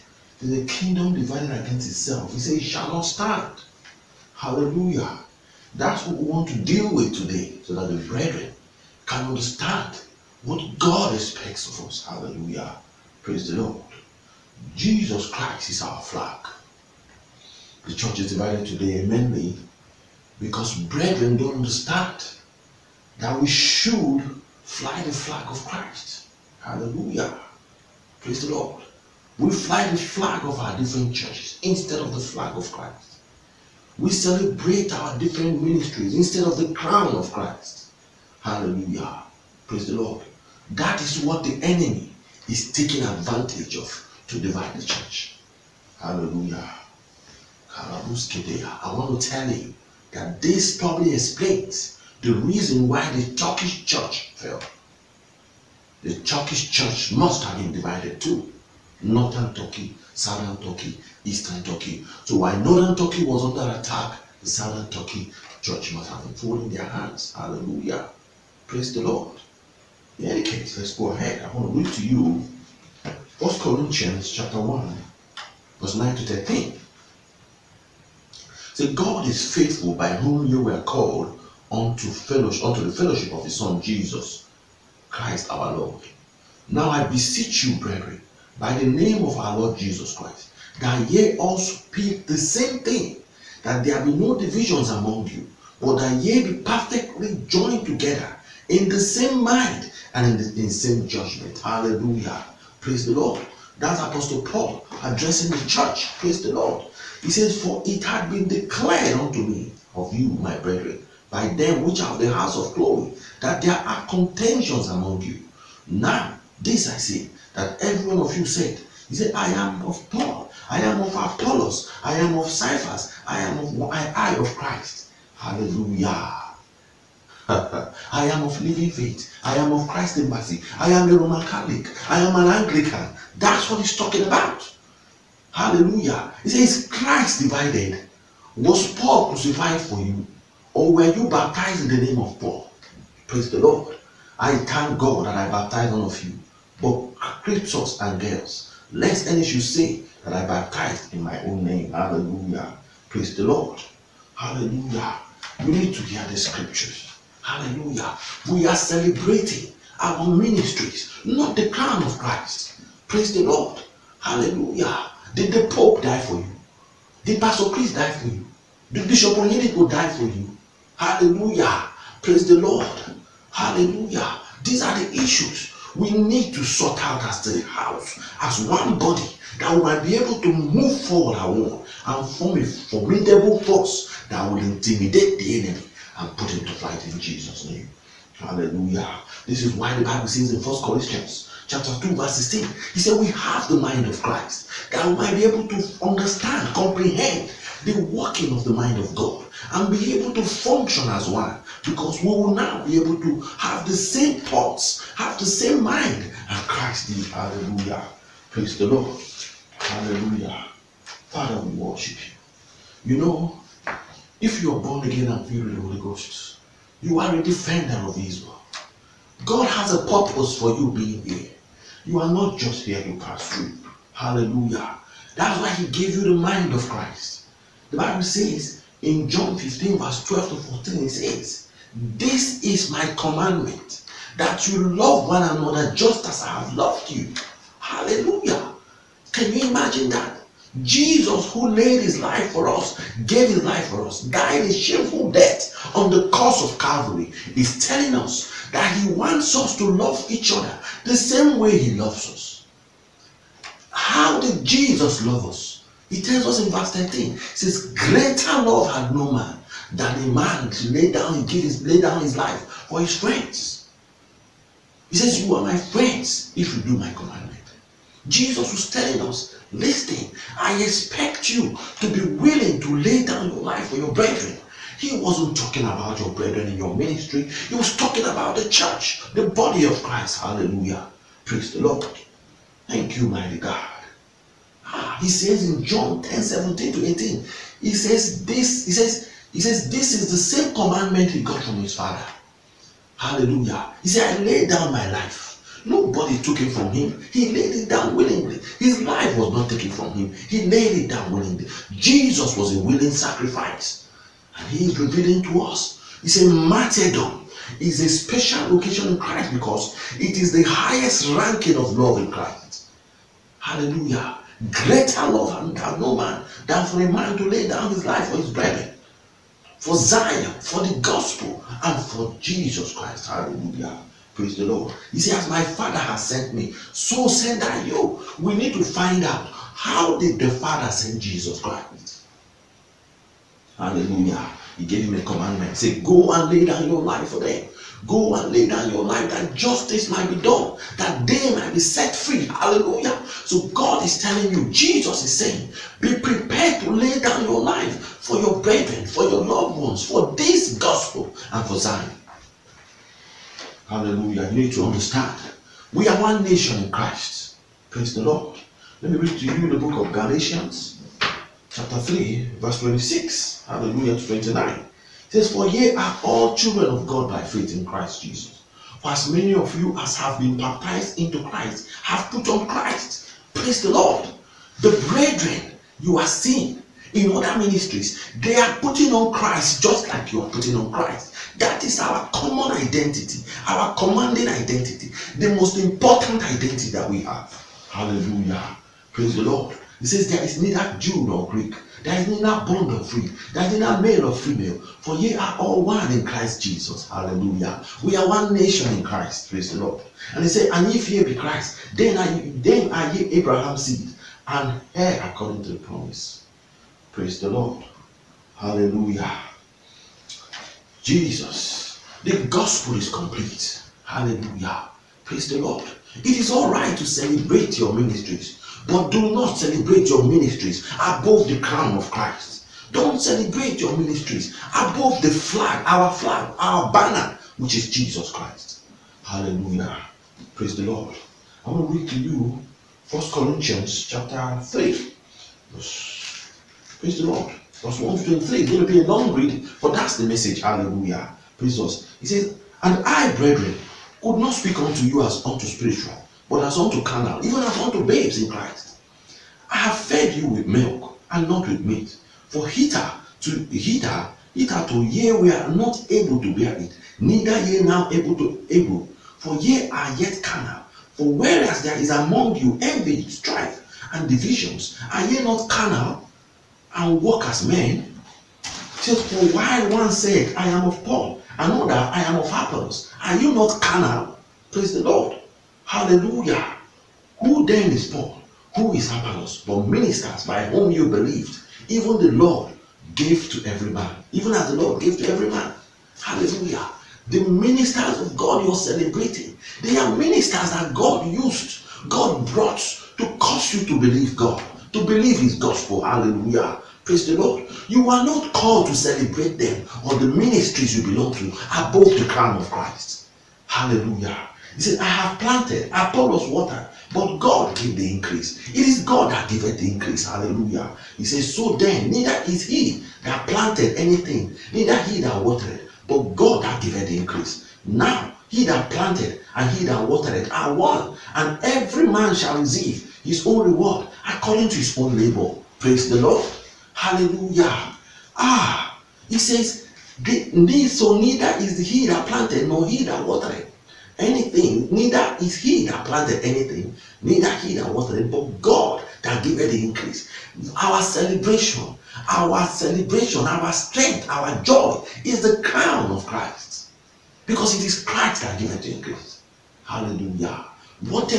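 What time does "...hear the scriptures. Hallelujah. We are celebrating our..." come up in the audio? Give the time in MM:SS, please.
02:36.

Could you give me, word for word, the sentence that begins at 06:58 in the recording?
But do not celebrate your ministries above the crown of Christ.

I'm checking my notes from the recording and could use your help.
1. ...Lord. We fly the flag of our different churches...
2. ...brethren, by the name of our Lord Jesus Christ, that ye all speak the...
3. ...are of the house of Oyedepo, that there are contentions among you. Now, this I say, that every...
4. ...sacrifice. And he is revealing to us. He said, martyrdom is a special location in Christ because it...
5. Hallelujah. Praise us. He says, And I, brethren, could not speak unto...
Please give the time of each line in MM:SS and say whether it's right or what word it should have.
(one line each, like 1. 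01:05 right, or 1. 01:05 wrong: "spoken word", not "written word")
1. 00:28 right
2. 01:27 right
3. 01:52 wrong: "Chloe", not "Oyedepo"
4. 05:03 right
5. 07:20 right.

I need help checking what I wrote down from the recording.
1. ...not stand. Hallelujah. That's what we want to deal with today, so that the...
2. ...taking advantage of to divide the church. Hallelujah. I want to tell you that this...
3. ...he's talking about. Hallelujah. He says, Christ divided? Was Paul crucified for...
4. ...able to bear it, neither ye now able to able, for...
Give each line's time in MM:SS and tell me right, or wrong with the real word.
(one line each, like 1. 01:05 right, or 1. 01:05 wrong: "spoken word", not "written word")
1. 00:02 right
2. 00:42 right
3. 02:13 right
4. 07:36 right.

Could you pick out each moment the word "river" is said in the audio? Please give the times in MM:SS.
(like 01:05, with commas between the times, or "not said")
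not said.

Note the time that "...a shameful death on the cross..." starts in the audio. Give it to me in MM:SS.
04:04.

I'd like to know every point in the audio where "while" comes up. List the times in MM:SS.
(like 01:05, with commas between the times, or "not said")
01:02, 07:49.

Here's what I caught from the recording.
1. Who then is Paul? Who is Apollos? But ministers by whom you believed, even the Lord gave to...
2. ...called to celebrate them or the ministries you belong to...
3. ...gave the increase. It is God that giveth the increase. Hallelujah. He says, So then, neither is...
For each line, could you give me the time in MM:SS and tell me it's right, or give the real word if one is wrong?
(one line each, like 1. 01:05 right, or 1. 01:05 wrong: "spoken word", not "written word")
1. 07:57 right
2. 08:18 right
3. 08:27 right.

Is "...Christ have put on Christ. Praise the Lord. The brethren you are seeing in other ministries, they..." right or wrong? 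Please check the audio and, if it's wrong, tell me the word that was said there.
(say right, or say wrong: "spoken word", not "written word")
right.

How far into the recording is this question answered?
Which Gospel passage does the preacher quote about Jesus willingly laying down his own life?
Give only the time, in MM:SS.
04:45.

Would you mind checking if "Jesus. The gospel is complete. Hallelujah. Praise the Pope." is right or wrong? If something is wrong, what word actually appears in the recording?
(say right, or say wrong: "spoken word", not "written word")
wrong: "Lord", not "Pope".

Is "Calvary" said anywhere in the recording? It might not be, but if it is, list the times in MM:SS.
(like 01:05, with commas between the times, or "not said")
04:06.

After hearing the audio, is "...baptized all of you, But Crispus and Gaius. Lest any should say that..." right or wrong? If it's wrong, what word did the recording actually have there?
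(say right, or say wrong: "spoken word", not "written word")
right.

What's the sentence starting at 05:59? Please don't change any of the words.
Let me read to you the book of Galatians, chapter 3, verse 26.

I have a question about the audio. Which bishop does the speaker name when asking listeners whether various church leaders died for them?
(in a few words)
Bishop Oyedepo.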